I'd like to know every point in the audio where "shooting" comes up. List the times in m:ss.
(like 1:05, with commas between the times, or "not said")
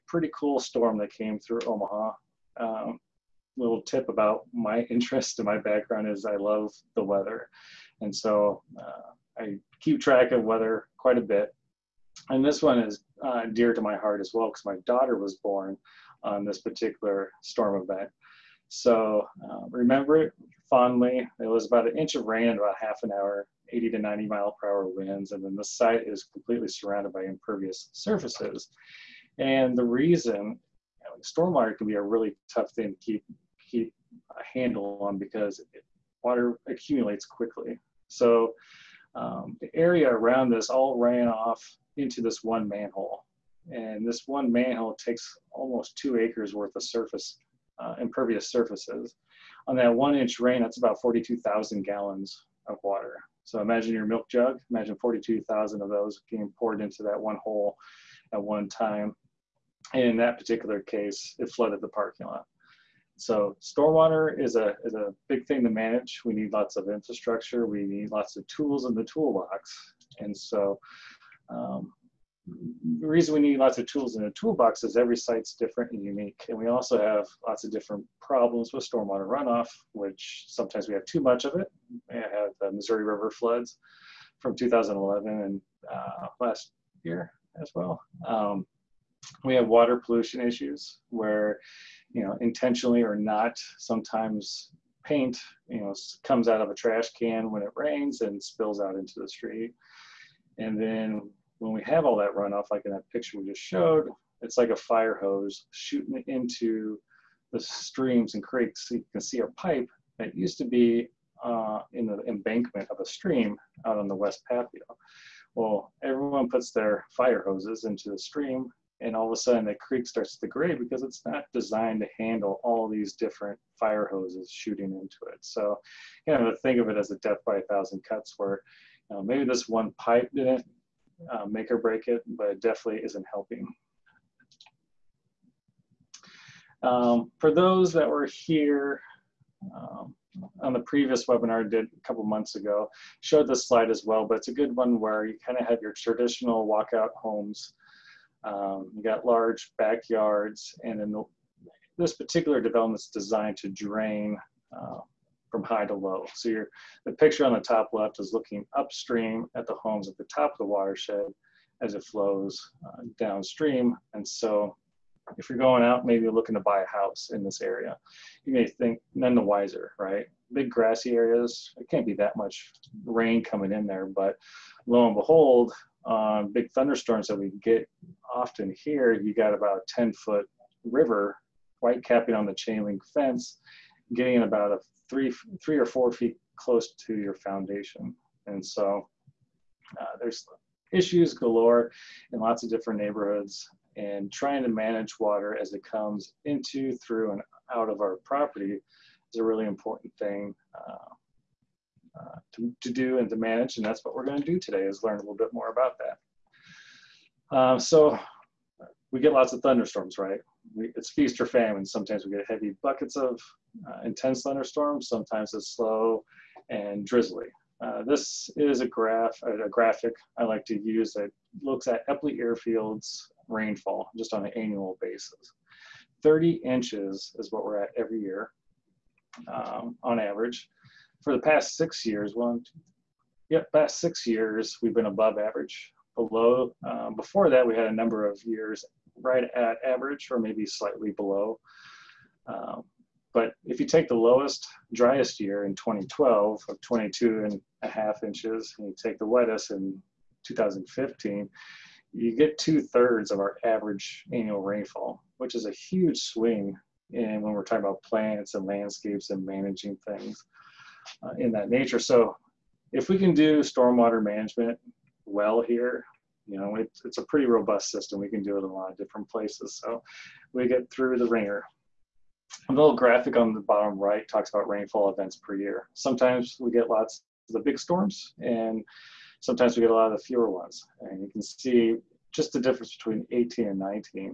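1:45, 2:04.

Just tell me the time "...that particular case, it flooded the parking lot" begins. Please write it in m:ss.
1:00.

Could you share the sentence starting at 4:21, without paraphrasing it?
So if we can do stormwater management well here, you know, it, it's a pretty robust system.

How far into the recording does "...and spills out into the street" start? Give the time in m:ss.
1:38.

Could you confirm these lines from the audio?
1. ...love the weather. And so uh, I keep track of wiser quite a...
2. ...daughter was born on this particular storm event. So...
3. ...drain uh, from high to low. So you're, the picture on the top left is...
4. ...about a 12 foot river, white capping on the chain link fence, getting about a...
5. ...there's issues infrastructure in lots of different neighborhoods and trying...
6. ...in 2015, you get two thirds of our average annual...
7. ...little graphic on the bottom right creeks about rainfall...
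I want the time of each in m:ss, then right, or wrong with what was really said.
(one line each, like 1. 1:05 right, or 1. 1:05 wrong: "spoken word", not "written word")
1. 0:06 wrong: "weather", not "wiser"
2. 0:14 right
3. 2:33 right
4. 2:59 wrong: "10", not "12"
5. 3:10 wrong: "galore", not "infrastructure"
6. 4:09 right
7. 4:32 wrong: "talks", not "creeks".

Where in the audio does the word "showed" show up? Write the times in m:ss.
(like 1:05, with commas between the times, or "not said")
1:43, 2:23.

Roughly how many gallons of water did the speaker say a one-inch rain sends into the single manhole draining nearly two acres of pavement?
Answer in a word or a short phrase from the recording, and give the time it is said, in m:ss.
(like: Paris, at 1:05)
42,000 gallons, at 0:50.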